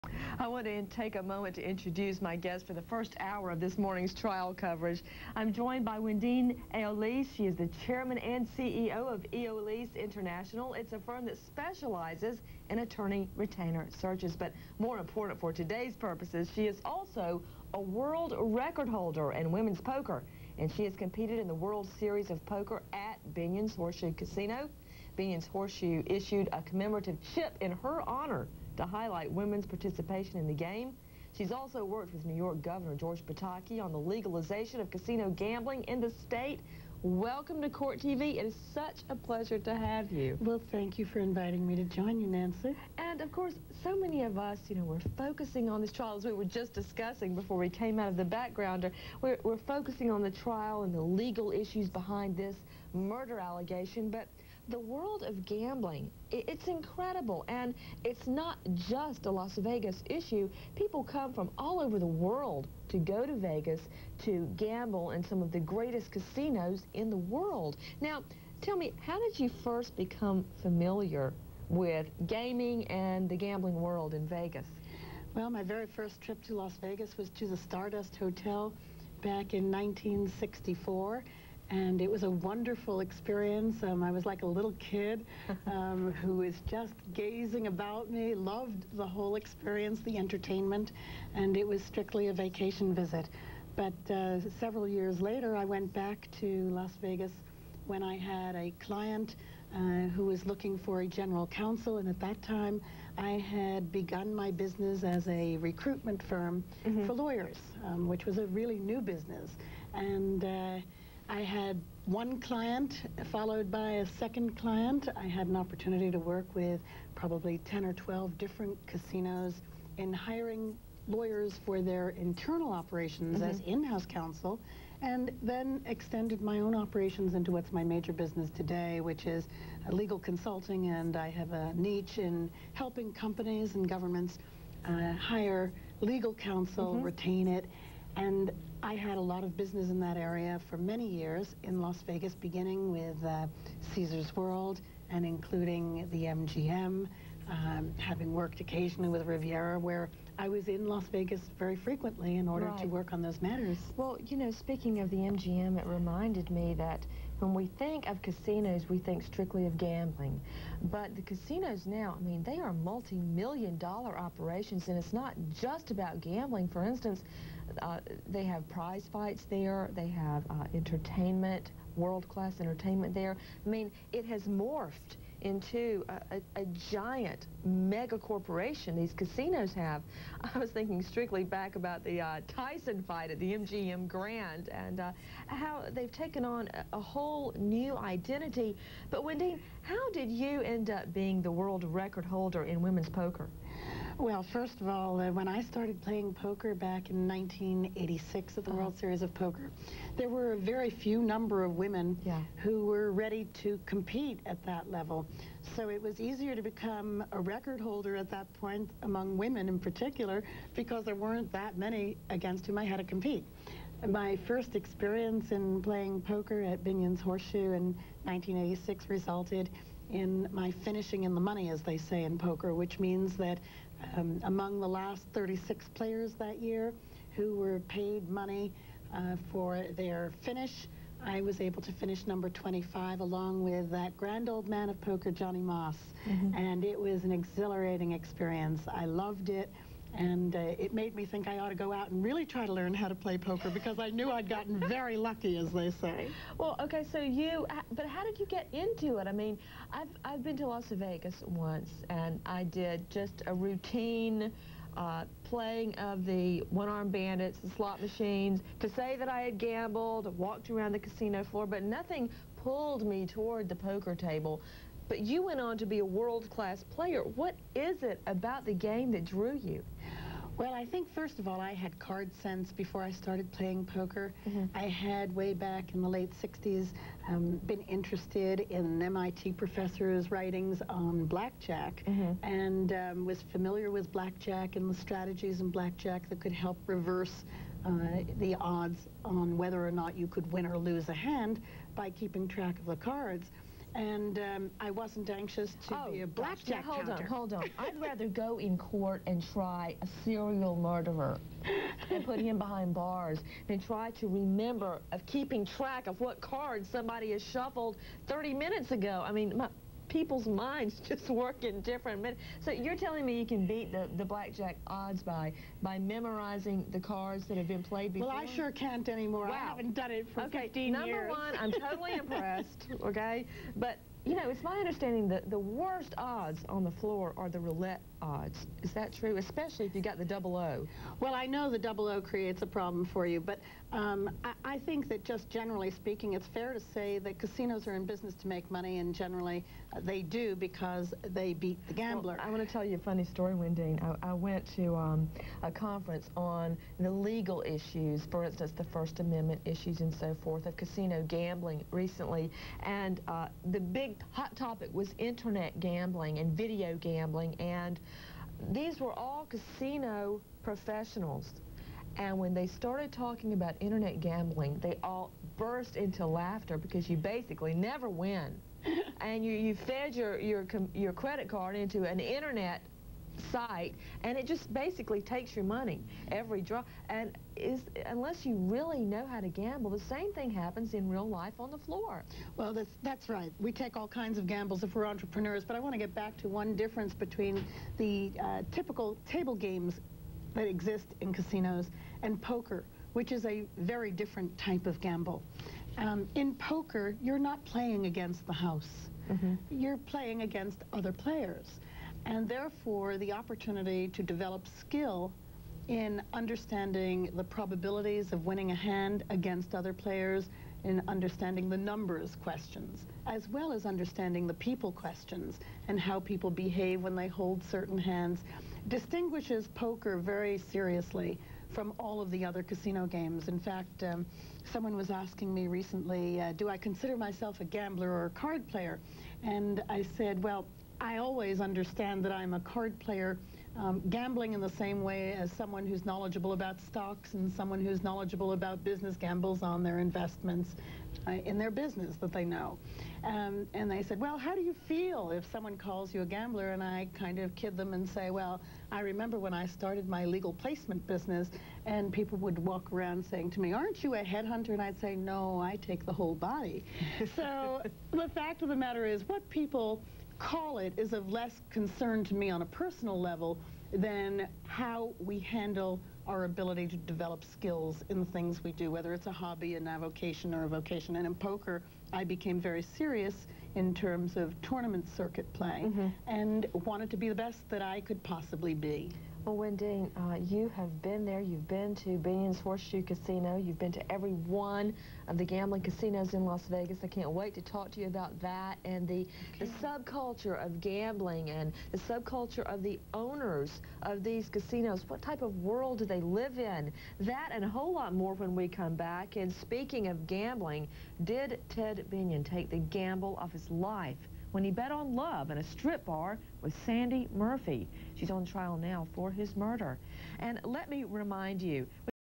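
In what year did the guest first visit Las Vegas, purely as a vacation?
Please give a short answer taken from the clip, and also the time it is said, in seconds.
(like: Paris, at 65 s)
1964, at 79 s.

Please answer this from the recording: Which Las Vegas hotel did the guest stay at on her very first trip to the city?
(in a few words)
Stardust Hotel.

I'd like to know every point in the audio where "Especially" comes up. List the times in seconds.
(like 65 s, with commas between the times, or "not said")
329 s.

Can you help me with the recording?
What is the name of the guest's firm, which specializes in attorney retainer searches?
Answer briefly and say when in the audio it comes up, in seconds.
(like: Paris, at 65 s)
Eolis International, at 9 s.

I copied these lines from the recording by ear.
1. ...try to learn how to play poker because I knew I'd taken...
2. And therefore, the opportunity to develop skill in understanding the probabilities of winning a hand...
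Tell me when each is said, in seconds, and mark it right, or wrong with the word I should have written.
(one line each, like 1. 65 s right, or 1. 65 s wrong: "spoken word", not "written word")
1. 242 s wrong: "gotten", not "taken"
2. 402 s right.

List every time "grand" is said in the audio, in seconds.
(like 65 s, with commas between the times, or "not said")
184 s, 234 s.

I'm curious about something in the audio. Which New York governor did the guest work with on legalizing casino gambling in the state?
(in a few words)
George Pataki.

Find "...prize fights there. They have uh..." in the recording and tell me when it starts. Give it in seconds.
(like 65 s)
168 s.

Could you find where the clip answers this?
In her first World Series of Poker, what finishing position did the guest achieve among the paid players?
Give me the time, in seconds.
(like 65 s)
232 s.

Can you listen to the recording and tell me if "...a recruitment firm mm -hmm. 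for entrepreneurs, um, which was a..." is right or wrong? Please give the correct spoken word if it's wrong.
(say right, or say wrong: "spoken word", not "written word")
wrong: "lawyers", not "entrepreneurs".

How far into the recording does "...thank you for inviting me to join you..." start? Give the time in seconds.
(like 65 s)
40 s.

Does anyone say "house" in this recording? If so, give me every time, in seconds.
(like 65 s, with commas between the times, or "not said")
123 s, 398 s.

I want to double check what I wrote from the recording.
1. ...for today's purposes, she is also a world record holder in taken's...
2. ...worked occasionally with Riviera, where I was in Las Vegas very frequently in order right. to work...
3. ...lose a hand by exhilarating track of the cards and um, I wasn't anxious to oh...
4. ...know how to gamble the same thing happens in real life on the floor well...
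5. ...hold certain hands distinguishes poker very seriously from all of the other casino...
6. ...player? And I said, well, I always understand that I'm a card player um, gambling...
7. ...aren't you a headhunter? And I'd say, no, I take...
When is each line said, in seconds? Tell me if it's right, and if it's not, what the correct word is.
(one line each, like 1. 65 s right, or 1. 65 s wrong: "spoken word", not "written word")
1. 15 s wrong: "women", not "taken"
2. 148 s right
3. 290 s wrong: "keeping", not "exhilarating"
4. 378 s right
5. 417 s right
6. 428 s right
7. 453 s right.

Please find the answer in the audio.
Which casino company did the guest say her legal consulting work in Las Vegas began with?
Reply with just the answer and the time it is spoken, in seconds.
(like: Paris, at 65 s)
Caesar's World, at 143 s.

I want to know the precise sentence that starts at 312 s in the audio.
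So you're telling me you can beat the, the blackjack odds by by memorizing the cards that have been played before?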